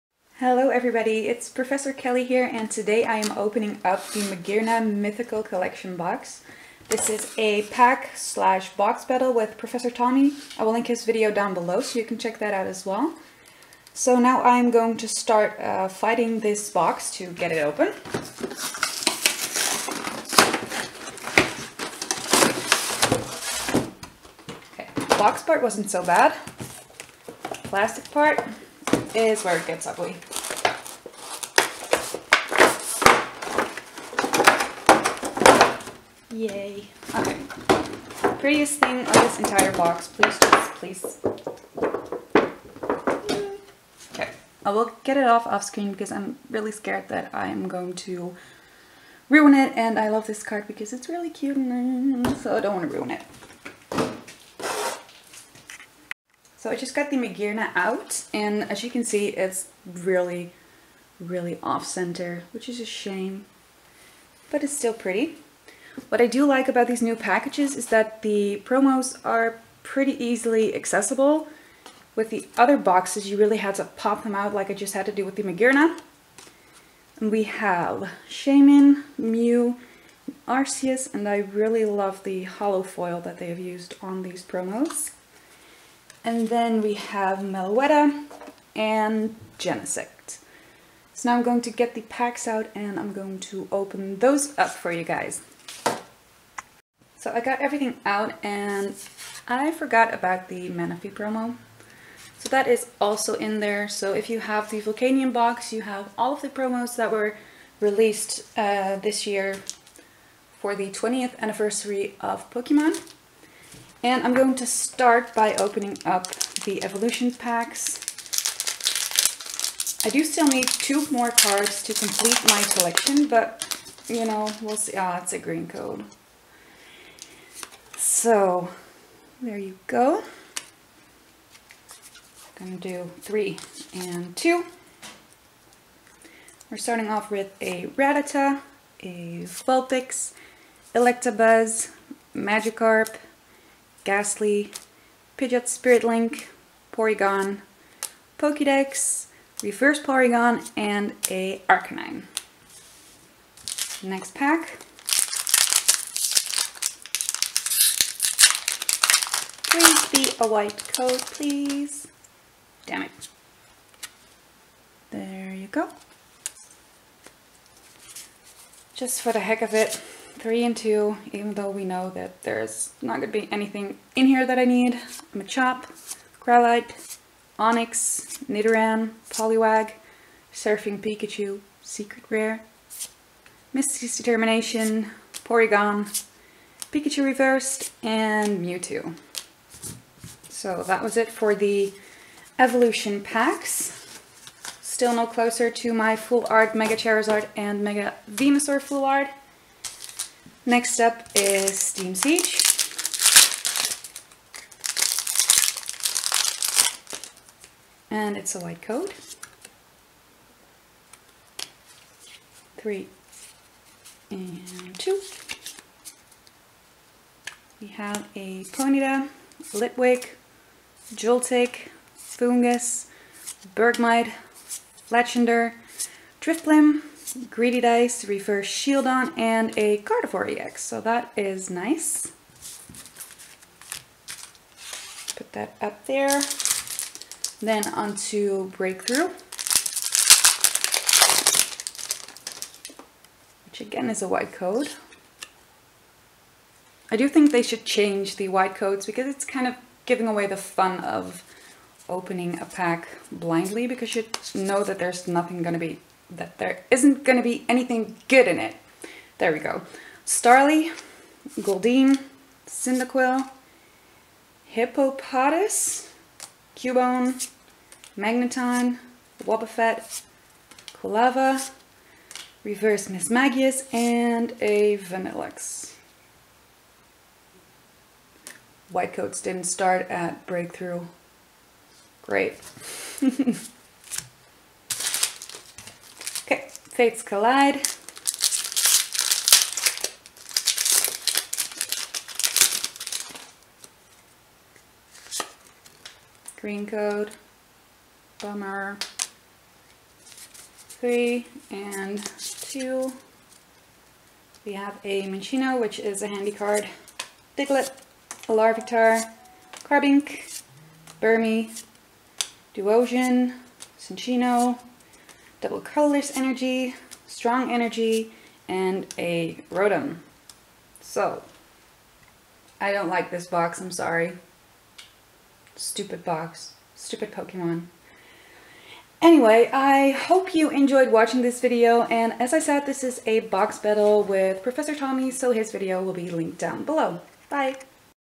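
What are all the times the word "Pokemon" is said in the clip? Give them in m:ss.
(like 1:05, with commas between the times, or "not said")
1:52, 5:27.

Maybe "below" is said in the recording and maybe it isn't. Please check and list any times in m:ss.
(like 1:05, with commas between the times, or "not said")
0:11, 5:36.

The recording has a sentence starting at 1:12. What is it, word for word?
With the other boxes, you really had to pop them out like I just had to do with the Magearna.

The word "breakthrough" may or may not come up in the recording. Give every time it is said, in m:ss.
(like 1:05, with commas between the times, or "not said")
3:58, 4:40.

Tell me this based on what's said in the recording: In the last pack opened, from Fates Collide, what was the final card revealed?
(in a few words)
Rotom.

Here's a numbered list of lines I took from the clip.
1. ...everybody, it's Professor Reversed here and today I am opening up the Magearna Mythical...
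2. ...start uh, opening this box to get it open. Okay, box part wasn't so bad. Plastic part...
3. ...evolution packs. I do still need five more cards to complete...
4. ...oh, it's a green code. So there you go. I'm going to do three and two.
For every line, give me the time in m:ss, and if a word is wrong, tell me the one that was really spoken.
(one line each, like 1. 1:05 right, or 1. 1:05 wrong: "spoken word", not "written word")
1. 0:00 wrong: "Kelly", not "Reversed"
2. 0:15 wrong: "fighting", not "opening"
3. 1:56 wrong: "two", not "five"
4. 2:05 right.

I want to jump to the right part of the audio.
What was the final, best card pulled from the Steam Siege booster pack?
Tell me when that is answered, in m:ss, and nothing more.
3:49.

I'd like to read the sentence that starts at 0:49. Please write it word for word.
And I love this card because it's really cute and so oh, I don't want to ruin it.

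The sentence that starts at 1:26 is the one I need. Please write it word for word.
And then we have Meloetta and Genesect.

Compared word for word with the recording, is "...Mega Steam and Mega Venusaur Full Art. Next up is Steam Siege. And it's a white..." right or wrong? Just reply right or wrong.
wrong.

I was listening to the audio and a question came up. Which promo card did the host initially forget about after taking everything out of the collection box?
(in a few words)
Manaphy.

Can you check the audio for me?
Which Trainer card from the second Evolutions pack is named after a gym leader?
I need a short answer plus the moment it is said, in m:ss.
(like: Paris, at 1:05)
Misty's Determination, at 3:03.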